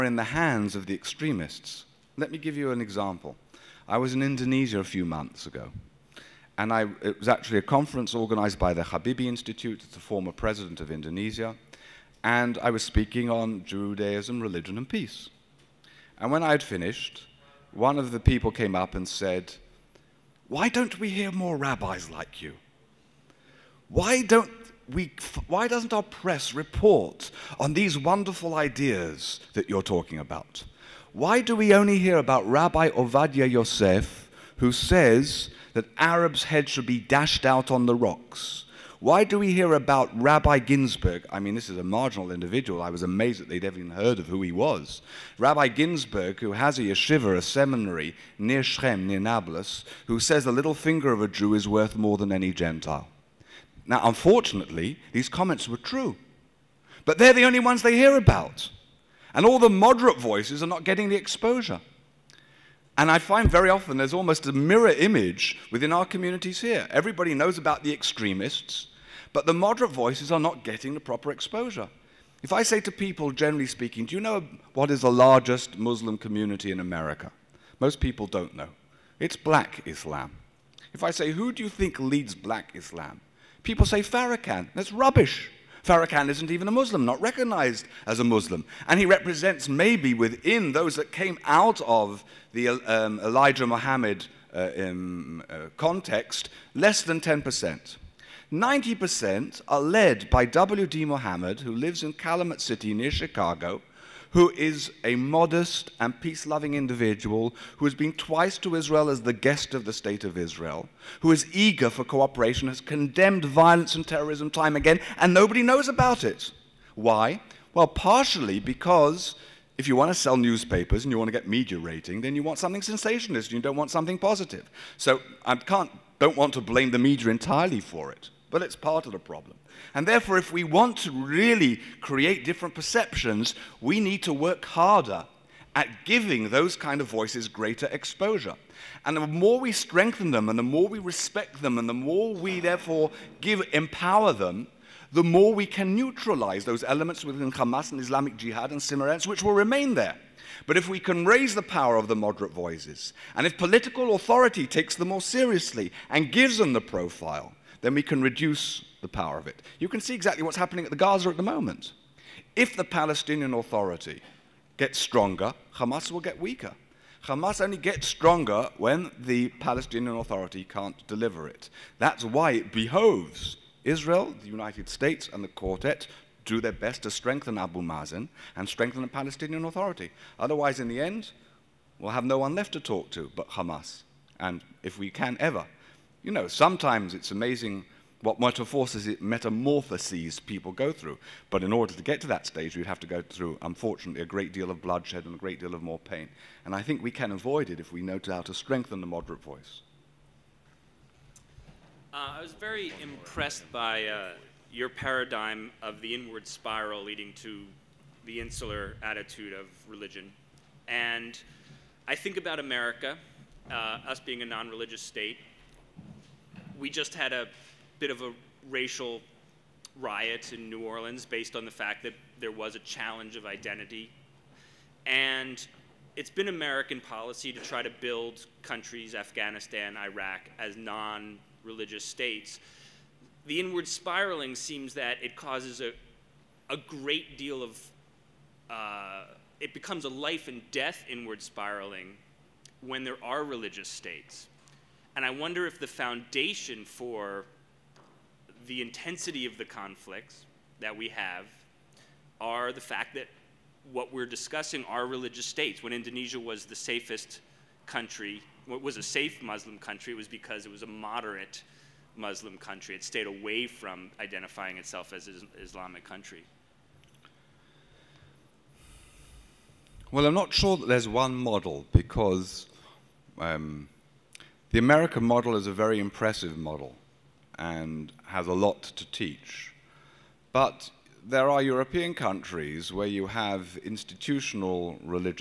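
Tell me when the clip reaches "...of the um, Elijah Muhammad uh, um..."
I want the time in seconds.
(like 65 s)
91 s.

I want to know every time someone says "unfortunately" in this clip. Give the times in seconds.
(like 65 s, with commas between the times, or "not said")
54 s, 193 s.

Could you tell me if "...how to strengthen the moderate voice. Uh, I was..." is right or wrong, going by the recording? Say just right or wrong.
right.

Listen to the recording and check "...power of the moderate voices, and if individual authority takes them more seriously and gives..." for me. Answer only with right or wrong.
wrong.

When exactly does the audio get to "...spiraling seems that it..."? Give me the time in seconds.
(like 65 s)
233 s.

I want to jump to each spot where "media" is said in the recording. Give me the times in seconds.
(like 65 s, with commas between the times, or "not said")
121 s, 126 s.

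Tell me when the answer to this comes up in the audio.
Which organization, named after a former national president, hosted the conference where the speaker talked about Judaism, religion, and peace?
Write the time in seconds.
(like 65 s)
8 s.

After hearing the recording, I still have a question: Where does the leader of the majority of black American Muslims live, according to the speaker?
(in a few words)
Calumet City.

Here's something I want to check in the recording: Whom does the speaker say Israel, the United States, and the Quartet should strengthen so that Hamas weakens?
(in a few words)
Abu Mazen.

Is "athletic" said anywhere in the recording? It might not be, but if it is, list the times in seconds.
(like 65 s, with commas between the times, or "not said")
not said.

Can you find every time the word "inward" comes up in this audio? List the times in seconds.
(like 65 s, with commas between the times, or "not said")
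206 s, 233 s, 241 s.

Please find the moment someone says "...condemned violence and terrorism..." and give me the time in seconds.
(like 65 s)
112 s.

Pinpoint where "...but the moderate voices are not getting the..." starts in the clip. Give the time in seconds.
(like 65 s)
69 s.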